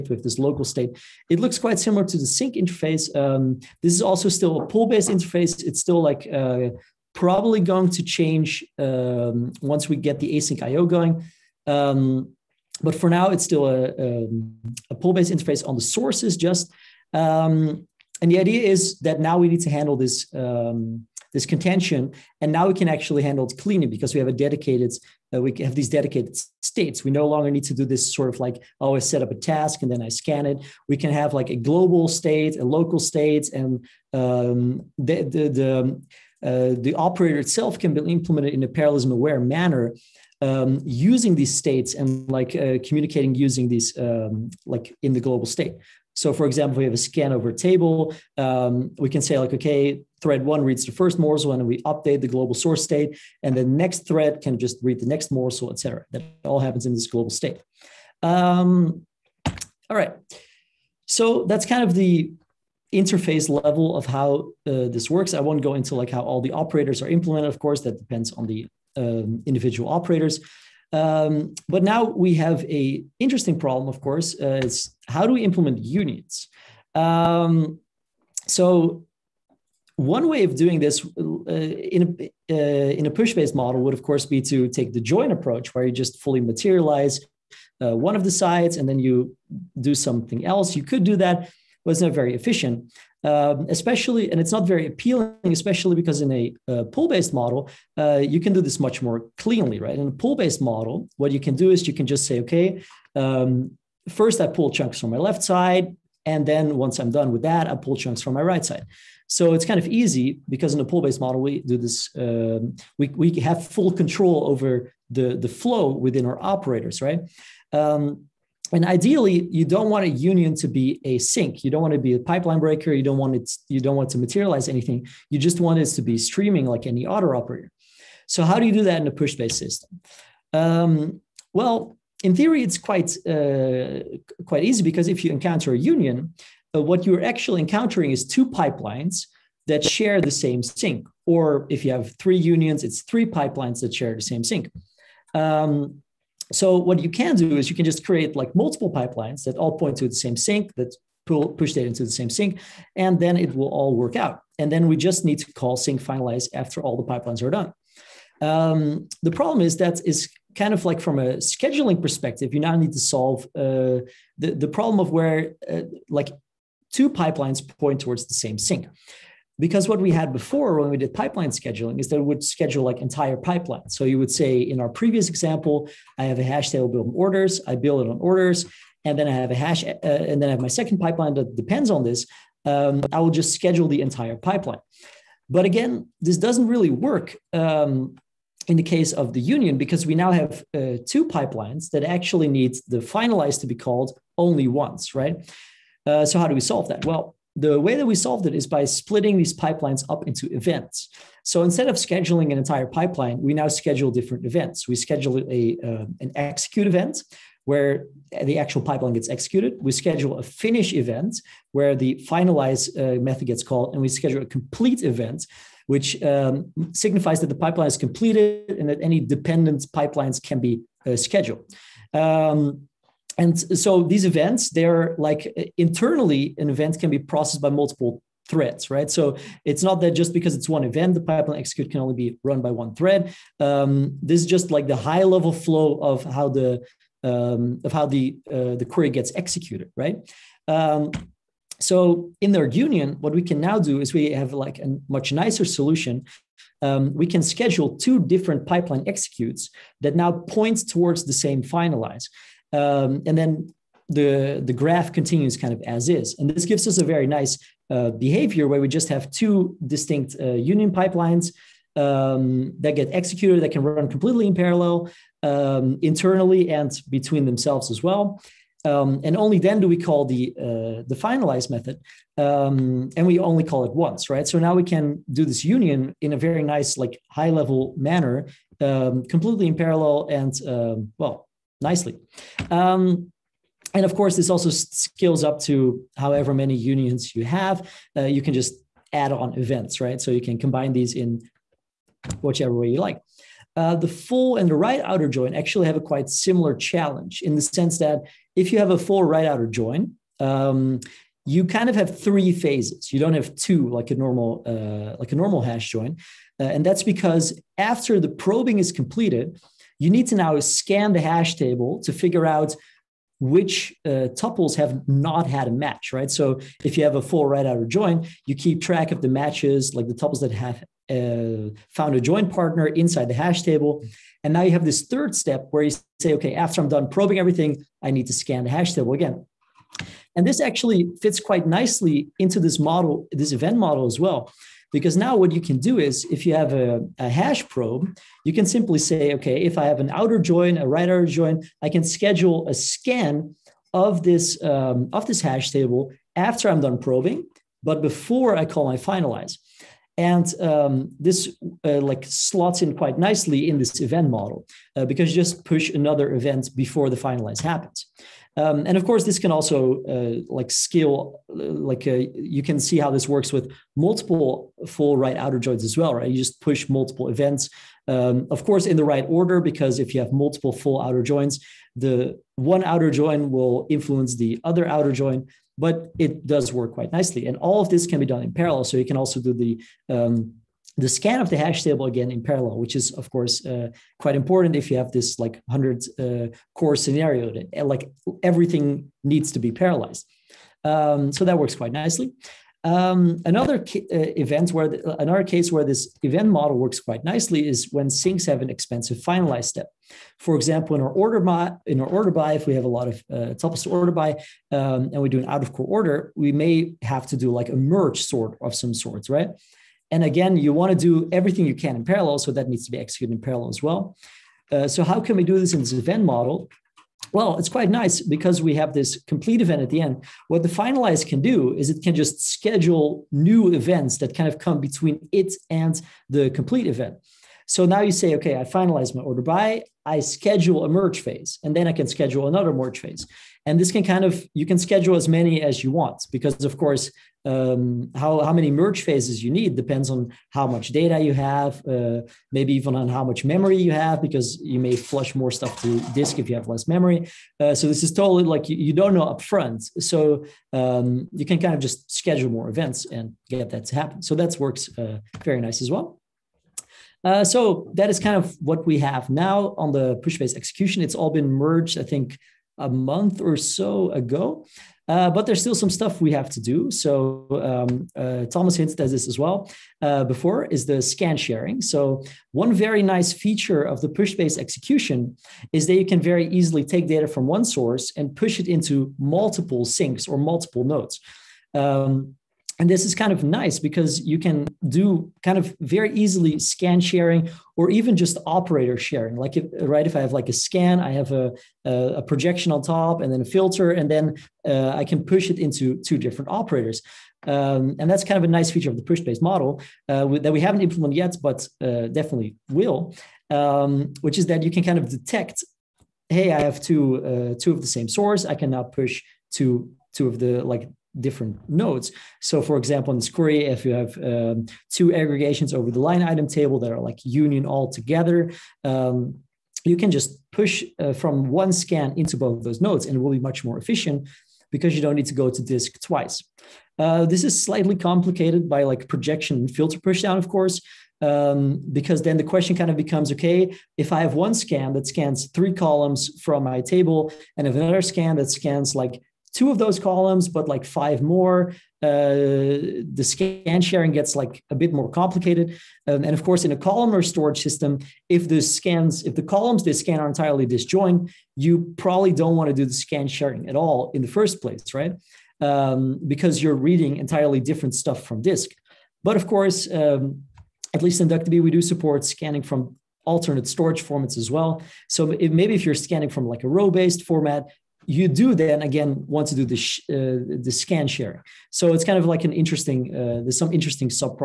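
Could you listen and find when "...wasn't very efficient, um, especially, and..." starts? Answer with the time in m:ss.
1:31.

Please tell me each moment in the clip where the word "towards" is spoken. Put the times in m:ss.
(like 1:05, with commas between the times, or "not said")
2:47, 4:10.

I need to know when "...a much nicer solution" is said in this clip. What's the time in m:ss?
4:04.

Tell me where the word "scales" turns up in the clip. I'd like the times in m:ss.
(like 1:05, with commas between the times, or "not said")
4:44, 6:00.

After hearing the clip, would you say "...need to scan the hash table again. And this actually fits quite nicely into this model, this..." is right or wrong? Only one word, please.
right.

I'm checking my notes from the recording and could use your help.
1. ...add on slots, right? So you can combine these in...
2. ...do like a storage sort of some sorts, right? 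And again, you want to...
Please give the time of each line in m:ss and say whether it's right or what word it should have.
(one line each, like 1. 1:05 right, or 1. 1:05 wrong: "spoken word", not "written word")
1. 4:49 wrong: "events", not "slots"
2. 6:47 wrong: "merge", not "storage".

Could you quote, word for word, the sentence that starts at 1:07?
Of course, that depends on the um, individual operators.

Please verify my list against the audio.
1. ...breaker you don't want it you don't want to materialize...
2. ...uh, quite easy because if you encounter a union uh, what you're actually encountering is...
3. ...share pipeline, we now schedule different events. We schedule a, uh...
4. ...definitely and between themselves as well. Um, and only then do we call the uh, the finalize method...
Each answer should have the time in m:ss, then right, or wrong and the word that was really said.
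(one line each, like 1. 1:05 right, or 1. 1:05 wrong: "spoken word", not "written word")
1. 2:02 right
2. 2:13 right
3. 3:22 wrong: "entire", not "share"
4. 4:26 wrong: "internally", not "definitely".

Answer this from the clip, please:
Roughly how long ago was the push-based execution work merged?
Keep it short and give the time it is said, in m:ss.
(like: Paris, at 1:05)
a month, at 7:42.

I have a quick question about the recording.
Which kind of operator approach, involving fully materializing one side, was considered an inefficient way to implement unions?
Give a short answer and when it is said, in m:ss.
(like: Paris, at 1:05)
the join approach, at 1:24.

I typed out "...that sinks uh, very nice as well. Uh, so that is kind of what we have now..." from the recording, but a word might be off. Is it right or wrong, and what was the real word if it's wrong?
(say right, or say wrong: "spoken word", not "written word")
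wrong: "works", not "sinks".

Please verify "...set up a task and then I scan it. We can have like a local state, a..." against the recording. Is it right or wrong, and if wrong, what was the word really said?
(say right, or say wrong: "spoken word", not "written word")
wrong: "global", not "local".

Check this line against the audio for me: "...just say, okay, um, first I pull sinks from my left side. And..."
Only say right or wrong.
wrong.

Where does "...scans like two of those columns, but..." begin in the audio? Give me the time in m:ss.
8:58.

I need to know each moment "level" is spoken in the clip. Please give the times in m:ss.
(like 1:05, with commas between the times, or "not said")
1:03, 3:55, 4:37.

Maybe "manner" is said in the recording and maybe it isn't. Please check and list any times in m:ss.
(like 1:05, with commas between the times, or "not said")
0:39, 4:37.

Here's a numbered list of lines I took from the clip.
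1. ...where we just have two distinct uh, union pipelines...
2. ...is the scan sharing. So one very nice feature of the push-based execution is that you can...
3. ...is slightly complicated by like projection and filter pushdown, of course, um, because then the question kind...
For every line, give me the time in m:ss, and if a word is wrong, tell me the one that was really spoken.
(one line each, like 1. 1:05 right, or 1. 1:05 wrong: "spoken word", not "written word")
1. 4:18 right
2. 7:50 right
3. 8:47 right.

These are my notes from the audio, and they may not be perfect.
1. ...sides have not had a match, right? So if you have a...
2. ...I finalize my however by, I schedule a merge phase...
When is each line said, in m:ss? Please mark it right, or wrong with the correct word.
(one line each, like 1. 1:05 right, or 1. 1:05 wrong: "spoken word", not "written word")
1. 5:14 wrong: "tuples", not "sides"
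2. 7:08 wrong: "order", not "however".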